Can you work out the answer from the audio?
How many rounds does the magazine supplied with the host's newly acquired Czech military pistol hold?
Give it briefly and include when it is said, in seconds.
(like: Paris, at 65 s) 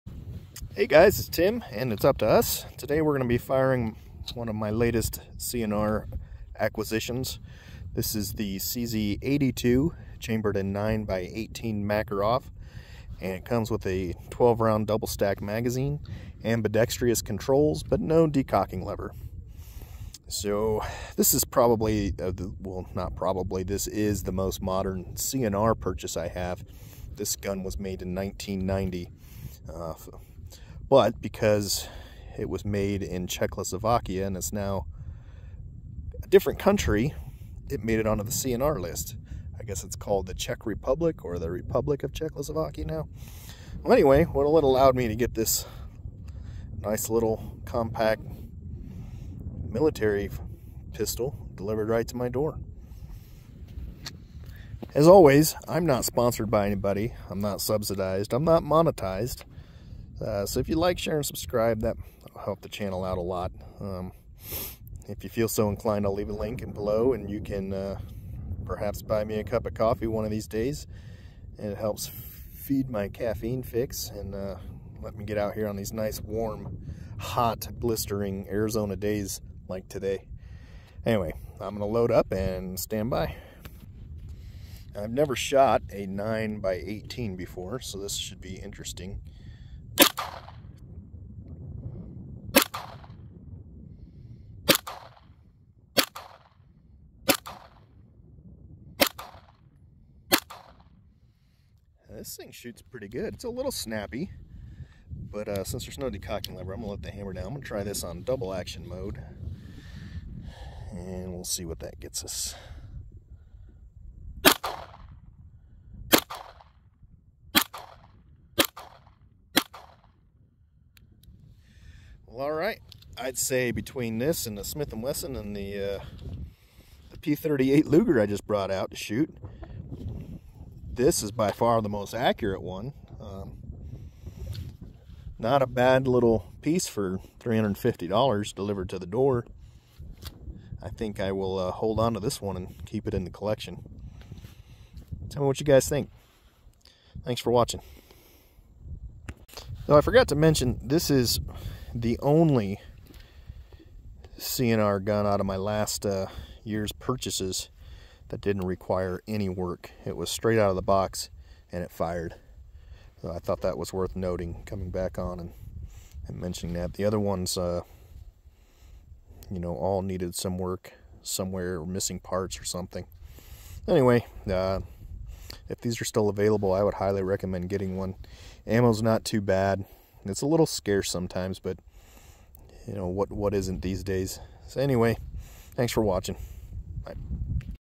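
12, at 14 s.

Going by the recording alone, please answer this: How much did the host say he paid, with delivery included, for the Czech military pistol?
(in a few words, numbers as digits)
$350.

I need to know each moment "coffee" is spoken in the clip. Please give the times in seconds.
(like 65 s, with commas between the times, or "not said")
69 s.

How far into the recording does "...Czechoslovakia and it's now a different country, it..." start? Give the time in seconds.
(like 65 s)
33 s.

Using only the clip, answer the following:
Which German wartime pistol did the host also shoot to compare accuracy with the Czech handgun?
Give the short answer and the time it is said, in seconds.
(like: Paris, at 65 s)
P38 Luger, at 127 s.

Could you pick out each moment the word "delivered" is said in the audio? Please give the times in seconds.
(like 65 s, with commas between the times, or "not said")
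51 s, 138 s.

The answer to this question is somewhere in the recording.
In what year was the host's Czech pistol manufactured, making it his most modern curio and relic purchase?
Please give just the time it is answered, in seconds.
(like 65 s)
28 s.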